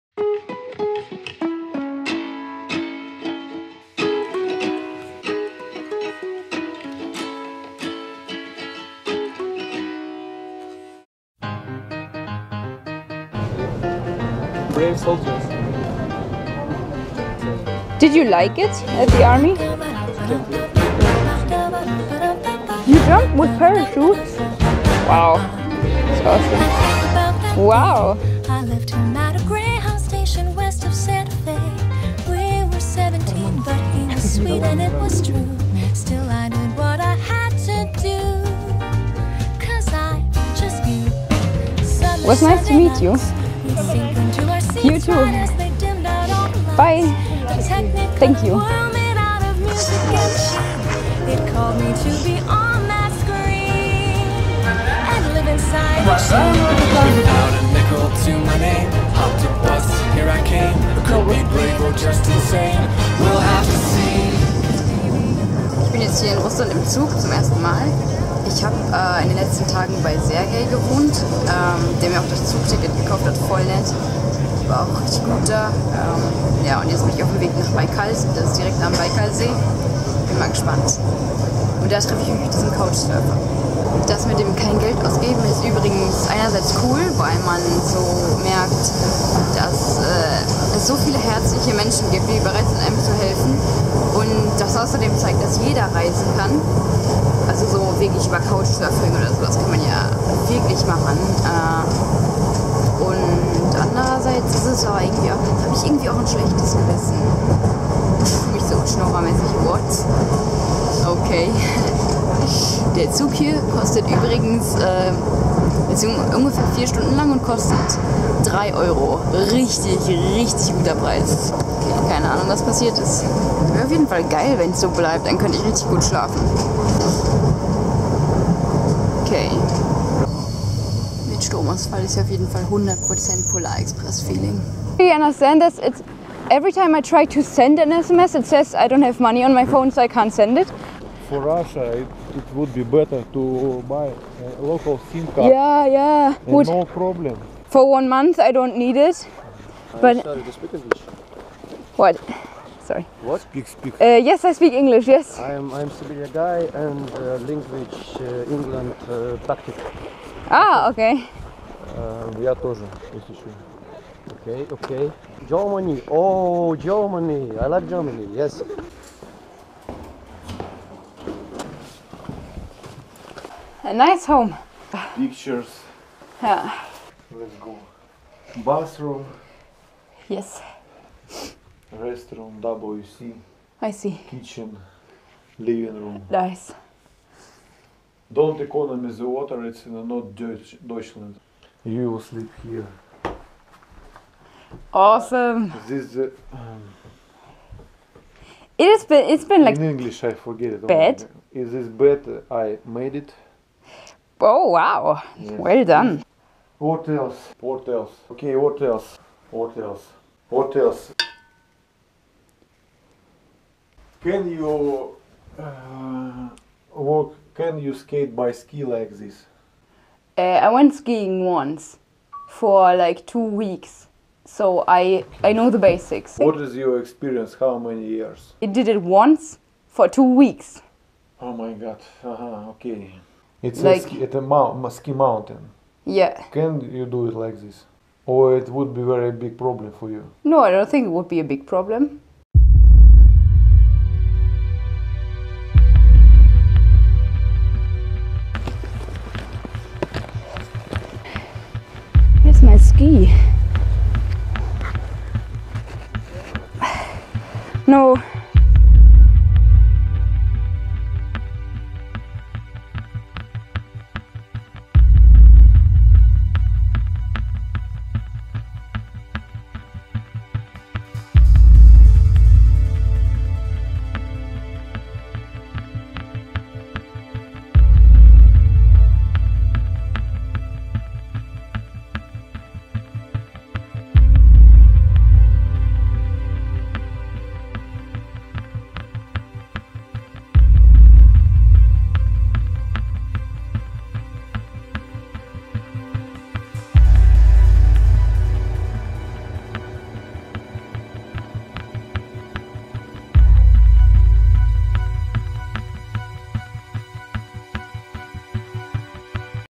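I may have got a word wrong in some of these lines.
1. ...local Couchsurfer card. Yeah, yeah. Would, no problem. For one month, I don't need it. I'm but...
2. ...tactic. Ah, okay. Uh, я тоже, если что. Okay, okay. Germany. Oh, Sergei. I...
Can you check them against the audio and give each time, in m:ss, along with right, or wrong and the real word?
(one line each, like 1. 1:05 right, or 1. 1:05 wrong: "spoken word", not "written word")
1. 2:24 wrong: "SIM", not "Couchsurfer"
2. 2:39 wrong: "Germany", not "Sergei".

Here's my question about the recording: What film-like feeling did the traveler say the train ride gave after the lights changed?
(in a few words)
Polar Express.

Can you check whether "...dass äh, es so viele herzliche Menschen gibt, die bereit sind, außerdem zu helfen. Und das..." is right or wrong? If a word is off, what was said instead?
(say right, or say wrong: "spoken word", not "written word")
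wrong: "einem", not "außerdem".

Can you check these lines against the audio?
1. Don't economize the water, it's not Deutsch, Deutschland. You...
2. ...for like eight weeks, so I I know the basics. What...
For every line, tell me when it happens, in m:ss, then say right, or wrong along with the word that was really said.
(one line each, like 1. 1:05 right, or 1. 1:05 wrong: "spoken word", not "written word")
1. 3:08 right
2. 3:42 wrong: "two", not "eight".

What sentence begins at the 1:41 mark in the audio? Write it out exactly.
Äh, das irgendwie auch, da habe ich irgendwie auch ein schlechtes Gewissen.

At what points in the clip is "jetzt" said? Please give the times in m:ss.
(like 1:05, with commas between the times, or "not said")
1:06, 1:16.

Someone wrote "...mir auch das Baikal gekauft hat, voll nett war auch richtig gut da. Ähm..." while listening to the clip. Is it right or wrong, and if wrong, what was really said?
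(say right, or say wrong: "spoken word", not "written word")
wrong: "Zugticket", not "Baikal".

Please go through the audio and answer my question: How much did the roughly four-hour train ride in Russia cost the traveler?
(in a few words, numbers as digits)
3 Euro.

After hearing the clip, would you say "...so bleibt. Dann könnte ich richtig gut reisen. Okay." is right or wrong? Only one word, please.
wrong.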